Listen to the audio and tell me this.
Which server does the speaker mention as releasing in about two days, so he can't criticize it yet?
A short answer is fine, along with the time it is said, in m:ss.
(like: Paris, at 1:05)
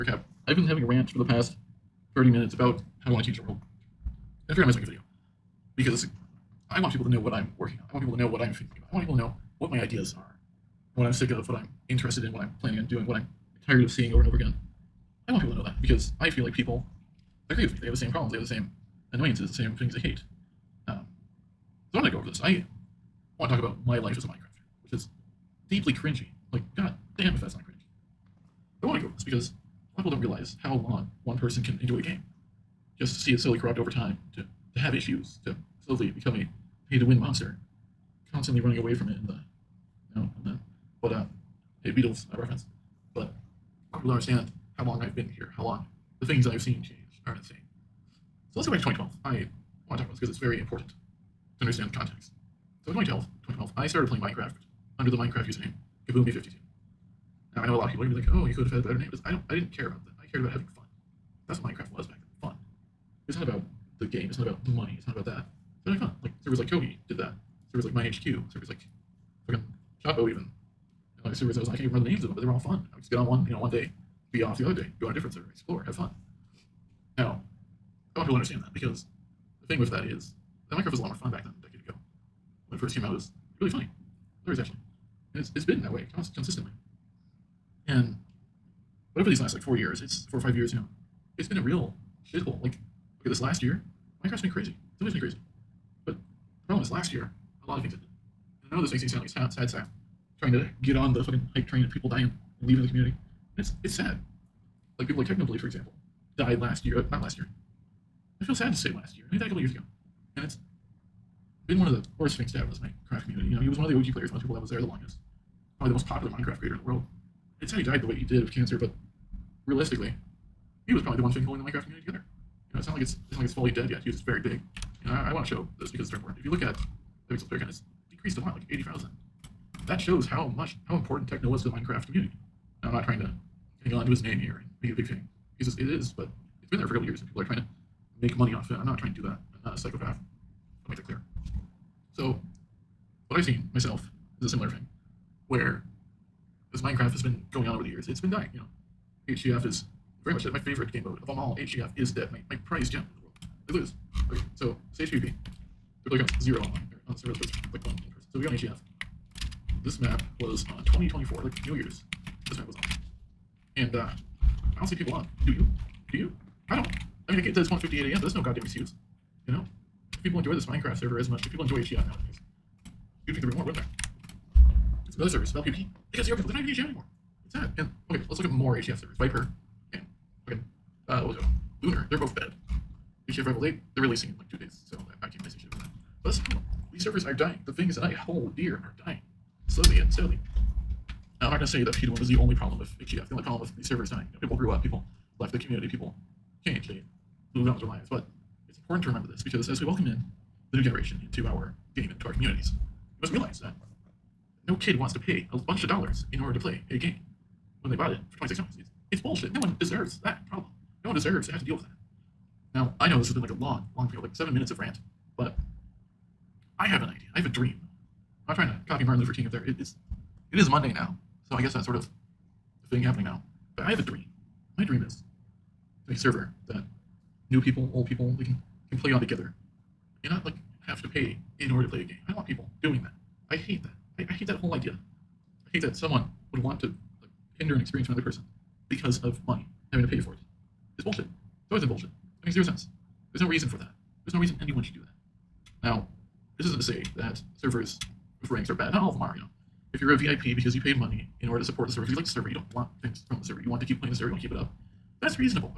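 Rebel, at 3:03.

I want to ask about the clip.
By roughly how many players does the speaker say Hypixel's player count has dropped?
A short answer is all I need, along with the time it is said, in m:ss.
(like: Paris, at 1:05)
80,000, at 2:08.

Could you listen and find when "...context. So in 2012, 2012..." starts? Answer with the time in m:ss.
0:51.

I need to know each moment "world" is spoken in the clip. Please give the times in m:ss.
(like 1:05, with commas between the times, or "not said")
0:03, 1:56, 2:33.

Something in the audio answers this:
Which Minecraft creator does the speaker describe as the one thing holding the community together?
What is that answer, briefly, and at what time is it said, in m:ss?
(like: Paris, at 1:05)
Technoblade, at 1:45.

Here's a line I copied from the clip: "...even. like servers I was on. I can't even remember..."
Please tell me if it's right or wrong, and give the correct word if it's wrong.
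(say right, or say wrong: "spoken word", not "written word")
right.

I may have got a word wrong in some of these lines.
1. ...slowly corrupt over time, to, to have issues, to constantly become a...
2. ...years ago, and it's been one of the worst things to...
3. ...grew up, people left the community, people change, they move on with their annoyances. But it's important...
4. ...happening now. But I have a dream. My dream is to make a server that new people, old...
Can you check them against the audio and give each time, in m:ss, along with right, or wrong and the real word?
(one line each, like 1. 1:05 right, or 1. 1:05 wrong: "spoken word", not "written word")
1. 0:33 wrong: "slowly", not "constantly"
2. 1:49 right
3. 3:14 wrong: "lives", not "annoyances"
4. 3:43 right.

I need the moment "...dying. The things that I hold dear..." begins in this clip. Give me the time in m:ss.
3:07.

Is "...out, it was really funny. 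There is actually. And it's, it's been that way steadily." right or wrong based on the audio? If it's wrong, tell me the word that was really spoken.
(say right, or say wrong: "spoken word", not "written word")
wrong: "consistently", not "steadily".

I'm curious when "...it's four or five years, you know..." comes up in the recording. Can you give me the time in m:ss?
1:30.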